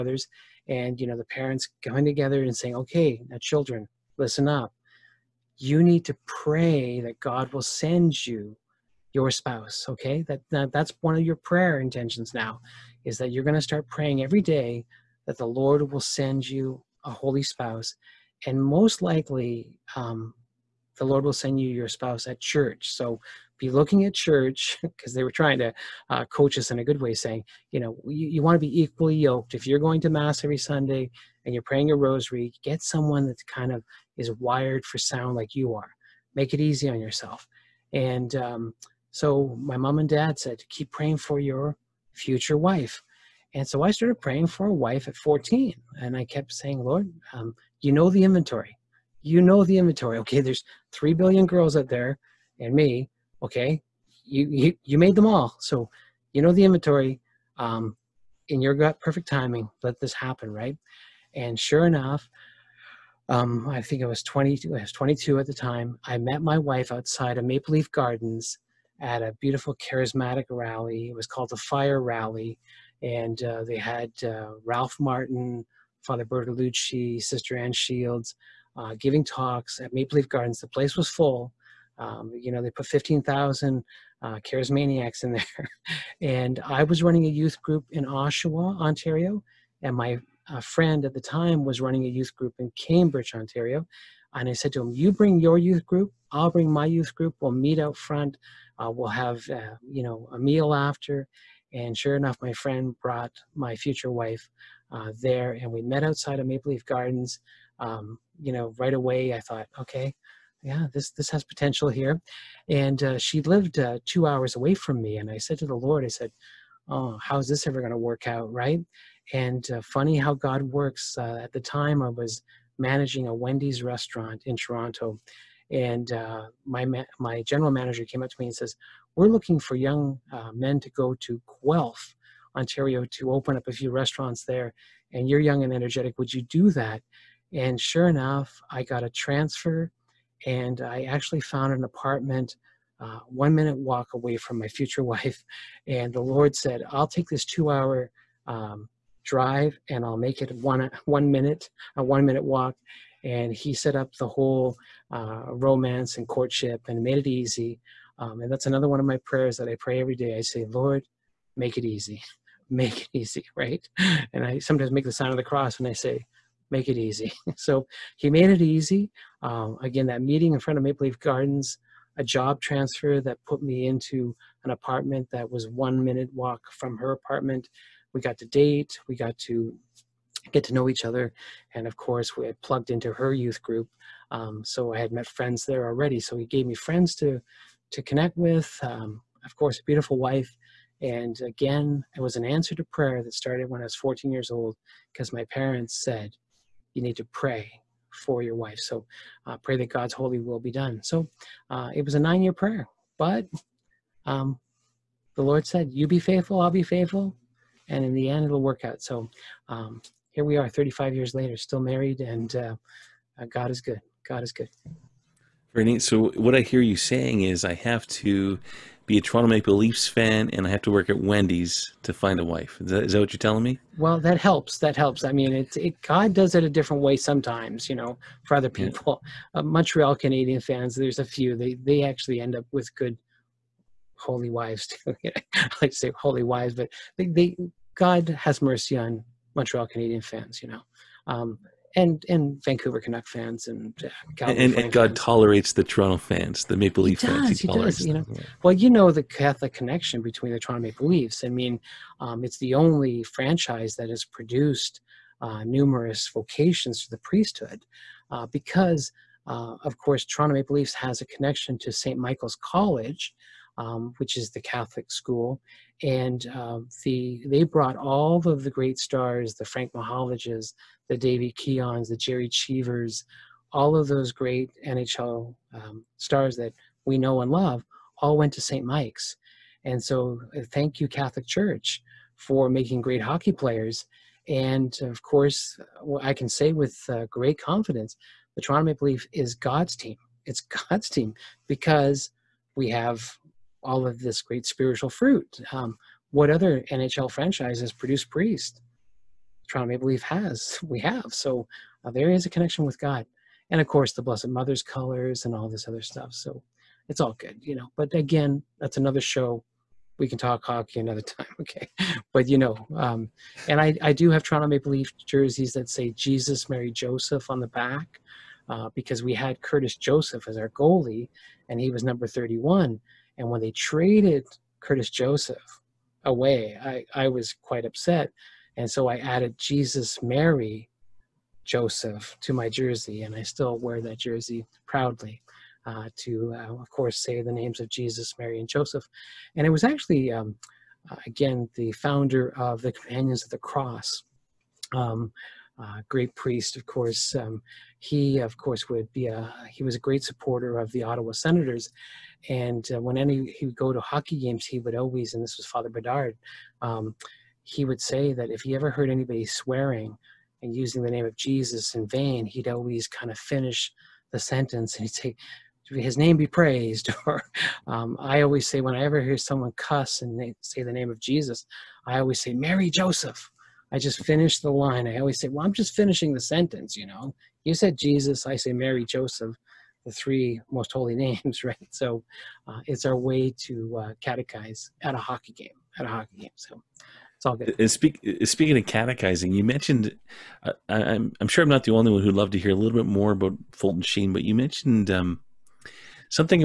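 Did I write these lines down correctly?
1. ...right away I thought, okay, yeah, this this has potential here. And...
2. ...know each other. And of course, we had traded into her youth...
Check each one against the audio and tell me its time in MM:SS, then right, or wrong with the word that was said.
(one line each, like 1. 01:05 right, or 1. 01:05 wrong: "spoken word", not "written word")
1. 01:48 right
2. 03:00 wrong: "plugged", not "traded".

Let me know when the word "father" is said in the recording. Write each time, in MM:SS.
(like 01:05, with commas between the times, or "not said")
01:16, 05:55.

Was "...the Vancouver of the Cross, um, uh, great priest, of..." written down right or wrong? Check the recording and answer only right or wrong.
wrong.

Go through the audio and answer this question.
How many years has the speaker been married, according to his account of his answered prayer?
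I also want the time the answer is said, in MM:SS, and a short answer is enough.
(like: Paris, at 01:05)
35, at 03:30.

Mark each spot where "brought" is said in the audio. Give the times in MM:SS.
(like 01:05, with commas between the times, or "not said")
01:43, 04:27.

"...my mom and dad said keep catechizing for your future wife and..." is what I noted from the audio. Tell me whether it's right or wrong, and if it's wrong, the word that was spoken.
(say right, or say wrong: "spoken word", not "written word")
wrong: "praying", not "catechizing".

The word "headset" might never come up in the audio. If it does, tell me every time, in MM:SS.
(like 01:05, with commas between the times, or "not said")
not said.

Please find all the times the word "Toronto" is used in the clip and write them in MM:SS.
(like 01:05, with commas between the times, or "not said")
02:04, 03:39, 04:05, 04:10, 04:20, 04:48, 04:59, 05:14.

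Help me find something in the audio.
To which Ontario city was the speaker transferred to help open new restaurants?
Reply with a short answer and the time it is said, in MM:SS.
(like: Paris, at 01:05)
Guelph, at 02:11.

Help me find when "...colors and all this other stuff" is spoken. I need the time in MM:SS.
05:04.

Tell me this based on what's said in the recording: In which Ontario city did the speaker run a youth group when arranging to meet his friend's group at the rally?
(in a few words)
Oshawa.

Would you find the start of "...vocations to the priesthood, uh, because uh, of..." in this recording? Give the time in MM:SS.
04:16.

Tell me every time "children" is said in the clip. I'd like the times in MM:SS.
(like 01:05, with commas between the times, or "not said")
00:03.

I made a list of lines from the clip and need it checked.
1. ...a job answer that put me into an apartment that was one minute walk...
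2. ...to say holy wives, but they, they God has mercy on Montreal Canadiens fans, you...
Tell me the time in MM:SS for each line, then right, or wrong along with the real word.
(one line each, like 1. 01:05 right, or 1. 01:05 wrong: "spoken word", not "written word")
1. 02:52 wrong: "transfer", not "answer"
2. 03:55 right.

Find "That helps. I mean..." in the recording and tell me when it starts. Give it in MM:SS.
03:44.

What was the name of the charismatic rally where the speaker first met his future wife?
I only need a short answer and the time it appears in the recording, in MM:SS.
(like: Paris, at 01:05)
the fire rally, at 01:11.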